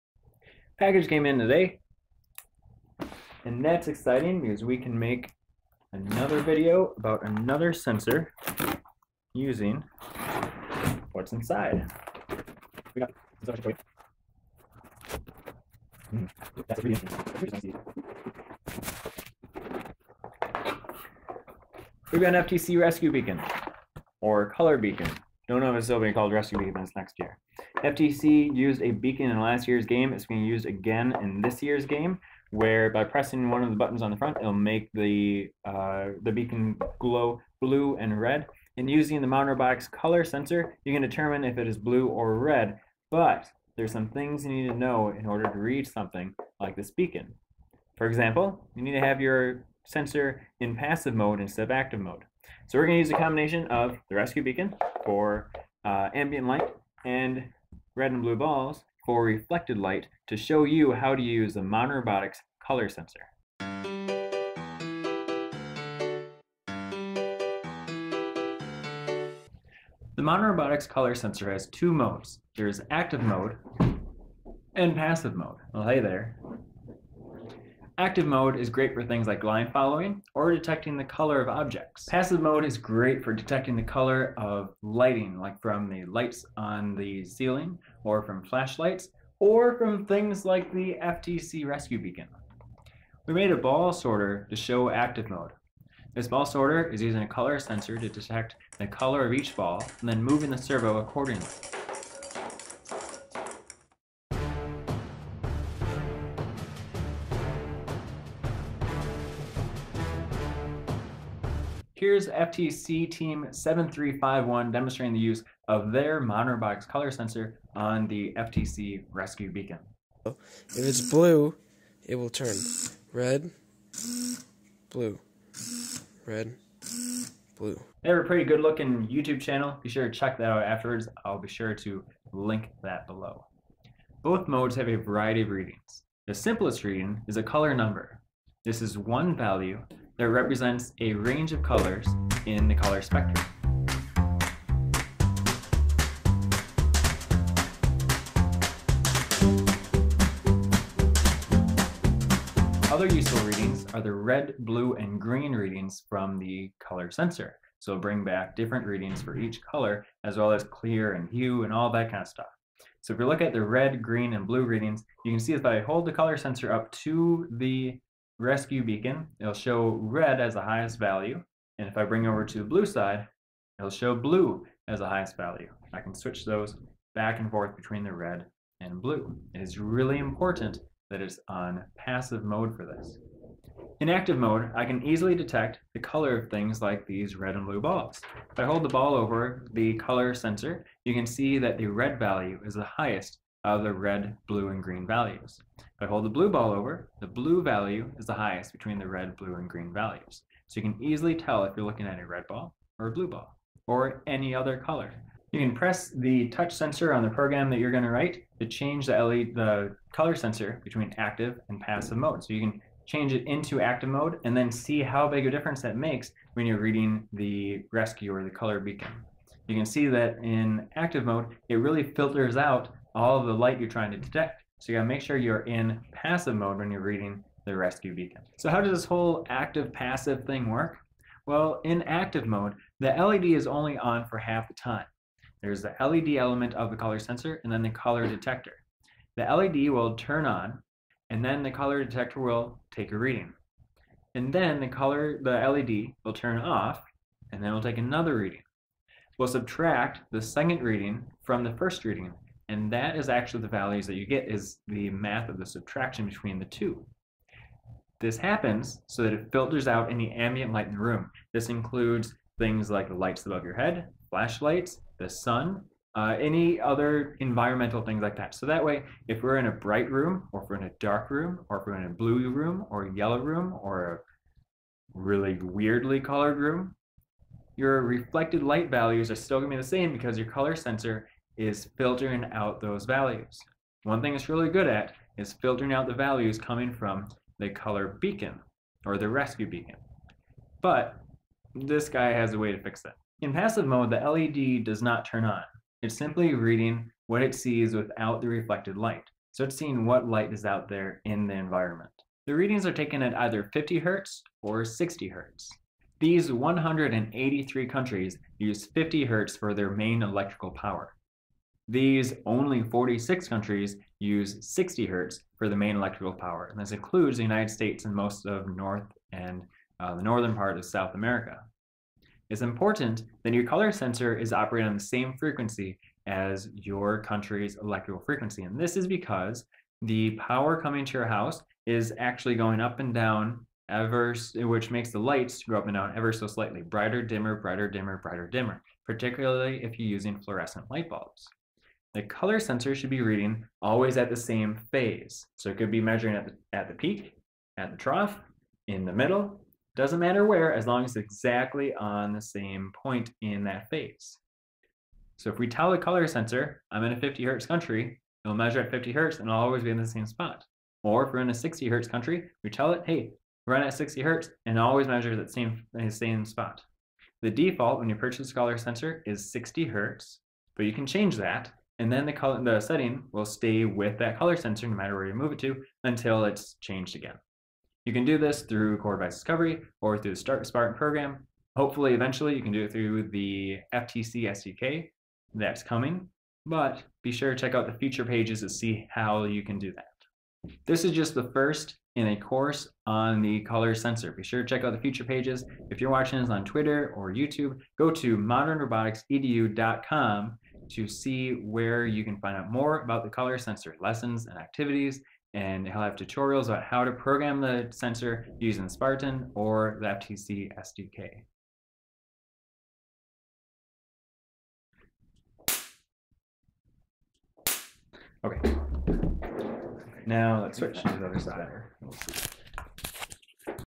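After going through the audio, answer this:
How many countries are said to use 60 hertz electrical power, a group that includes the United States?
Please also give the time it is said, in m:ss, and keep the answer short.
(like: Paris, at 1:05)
46, at 5:12.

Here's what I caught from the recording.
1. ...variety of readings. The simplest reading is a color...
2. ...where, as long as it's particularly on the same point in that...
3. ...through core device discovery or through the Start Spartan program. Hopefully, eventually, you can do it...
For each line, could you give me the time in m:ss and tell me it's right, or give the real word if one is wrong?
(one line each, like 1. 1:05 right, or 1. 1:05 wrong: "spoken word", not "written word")
1. 2:14 right
2. 5:50 wrong: "exactly", not "particularly"
3. 6:18 right.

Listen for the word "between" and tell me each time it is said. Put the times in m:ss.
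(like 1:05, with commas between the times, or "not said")
2:57, 3:18, 3:30, 4:16.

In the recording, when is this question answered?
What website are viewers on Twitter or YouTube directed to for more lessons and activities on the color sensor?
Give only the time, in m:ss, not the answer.
6:38.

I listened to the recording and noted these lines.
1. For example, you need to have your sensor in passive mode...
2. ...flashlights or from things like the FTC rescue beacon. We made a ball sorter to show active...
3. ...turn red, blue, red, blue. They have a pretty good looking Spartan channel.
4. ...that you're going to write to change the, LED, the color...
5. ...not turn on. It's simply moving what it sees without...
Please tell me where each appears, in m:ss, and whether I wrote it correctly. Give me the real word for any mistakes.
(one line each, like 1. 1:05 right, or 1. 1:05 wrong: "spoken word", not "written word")
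1. 0:47 right
2. 1:28 right
3. 2:02 wrong: "YouTube", not "Spartan"
4. 3:27 right
5. 4:55 wrong: "reading", not "moving".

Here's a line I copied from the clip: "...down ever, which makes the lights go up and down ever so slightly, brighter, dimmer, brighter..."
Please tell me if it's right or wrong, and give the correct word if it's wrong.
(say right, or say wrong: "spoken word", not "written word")
right.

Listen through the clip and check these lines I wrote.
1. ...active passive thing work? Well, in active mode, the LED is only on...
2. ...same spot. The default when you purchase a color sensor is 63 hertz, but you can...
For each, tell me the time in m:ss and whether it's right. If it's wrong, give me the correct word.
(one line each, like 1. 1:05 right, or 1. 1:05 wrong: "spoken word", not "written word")
1. 3:49 right
2. 6:06 wrong: "60", not "63".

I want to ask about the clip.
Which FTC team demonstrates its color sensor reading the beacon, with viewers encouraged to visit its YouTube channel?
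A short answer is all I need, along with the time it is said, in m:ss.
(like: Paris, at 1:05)
7351, at 1:52.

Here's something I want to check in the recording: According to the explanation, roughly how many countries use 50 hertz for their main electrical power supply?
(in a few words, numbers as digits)
183.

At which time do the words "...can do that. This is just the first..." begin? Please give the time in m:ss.
6:29.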